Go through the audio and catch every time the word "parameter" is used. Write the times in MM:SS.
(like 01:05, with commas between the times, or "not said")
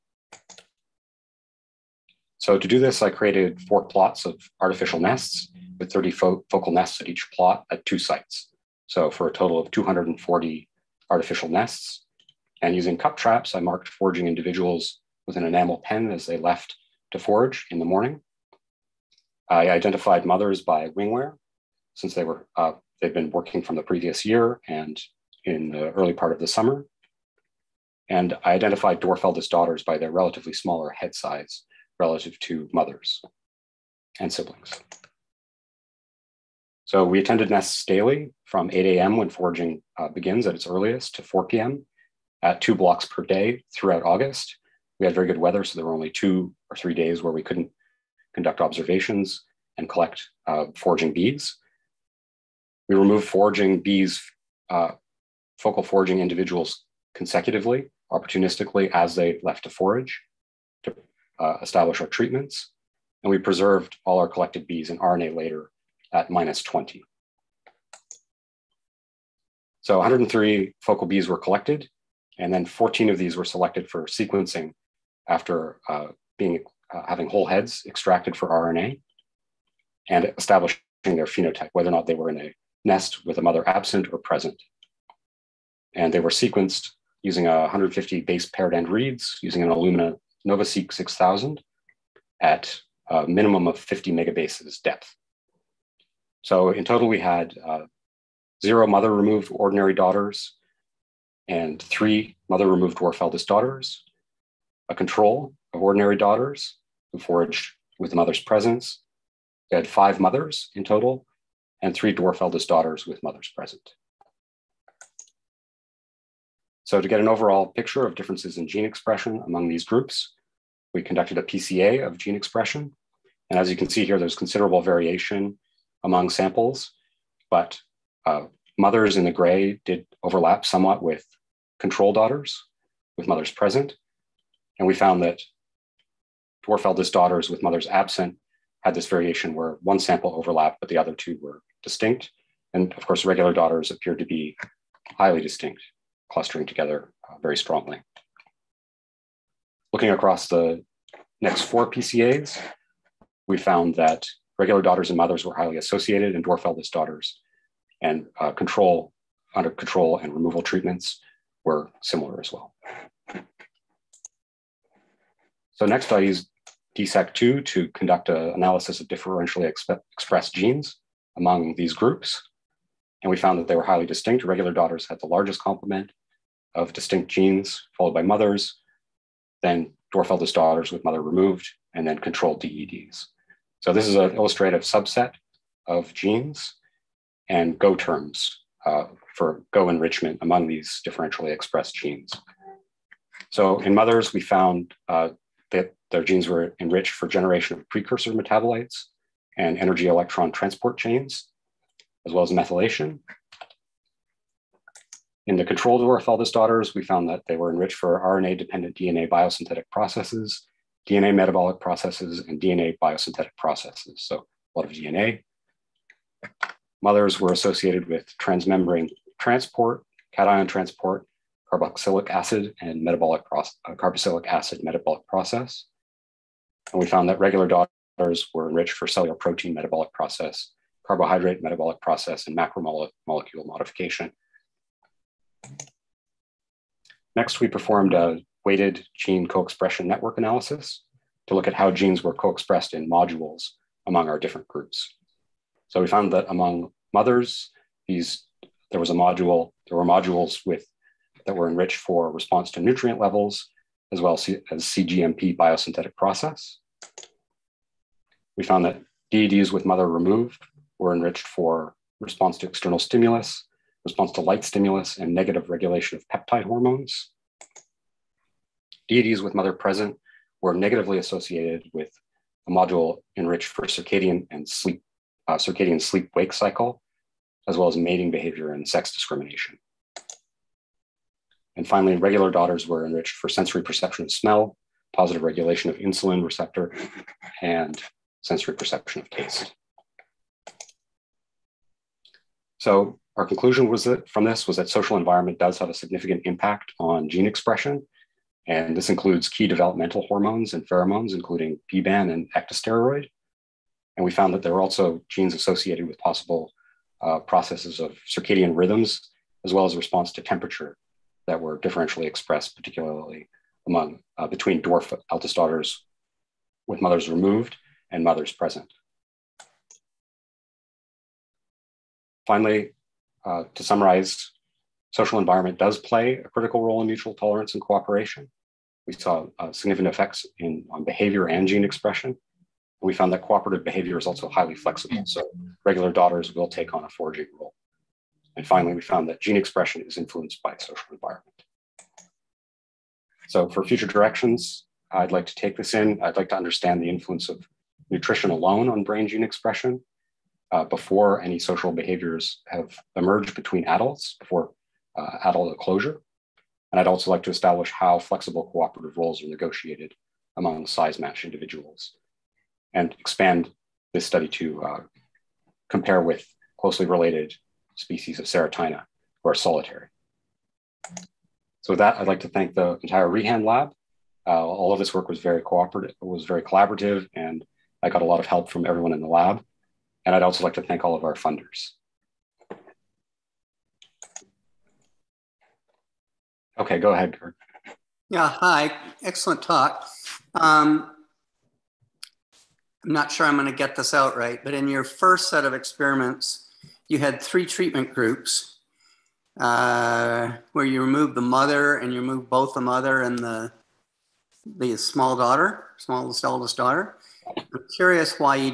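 not said.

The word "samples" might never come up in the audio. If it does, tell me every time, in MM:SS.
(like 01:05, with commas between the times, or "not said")
02:06, 02:19.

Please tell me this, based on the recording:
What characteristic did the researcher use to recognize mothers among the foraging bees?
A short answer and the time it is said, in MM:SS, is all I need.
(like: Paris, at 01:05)
wing wear, at 00:20.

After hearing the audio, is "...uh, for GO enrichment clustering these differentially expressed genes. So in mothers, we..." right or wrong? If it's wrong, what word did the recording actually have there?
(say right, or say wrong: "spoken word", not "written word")
wrong: "among", not "clustering".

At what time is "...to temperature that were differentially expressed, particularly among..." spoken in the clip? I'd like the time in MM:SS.
05:10.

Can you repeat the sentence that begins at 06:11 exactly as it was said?
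So with that, I'd like to thank the entire Rehan lab.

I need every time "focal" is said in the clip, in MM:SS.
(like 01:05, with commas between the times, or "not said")
00:06, 00:55, 01:10.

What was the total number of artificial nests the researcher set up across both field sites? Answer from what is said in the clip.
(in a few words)
240.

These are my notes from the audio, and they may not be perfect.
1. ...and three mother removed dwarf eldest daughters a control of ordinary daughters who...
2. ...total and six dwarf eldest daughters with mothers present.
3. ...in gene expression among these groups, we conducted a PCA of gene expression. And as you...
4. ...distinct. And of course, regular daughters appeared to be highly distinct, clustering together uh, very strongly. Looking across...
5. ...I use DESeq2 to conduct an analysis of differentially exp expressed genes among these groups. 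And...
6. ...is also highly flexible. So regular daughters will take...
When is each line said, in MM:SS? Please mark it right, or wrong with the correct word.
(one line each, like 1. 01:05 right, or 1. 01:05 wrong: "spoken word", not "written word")
1. 01:41 right
2. 01:50 wrong: "three", not "six"
3. 01:58 right
4. 02:21 right
5. 02:46 right
6. 05:34 right.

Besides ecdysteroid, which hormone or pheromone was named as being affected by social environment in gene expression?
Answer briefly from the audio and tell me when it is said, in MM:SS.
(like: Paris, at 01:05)
PBAN, at 05:01.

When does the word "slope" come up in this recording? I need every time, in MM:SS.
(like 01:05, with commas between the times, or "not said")
not said.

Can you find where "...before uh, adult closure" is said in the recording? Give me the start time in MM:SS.
05:54.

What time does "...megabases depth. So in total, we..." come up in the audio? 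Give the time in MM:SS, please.
01:34.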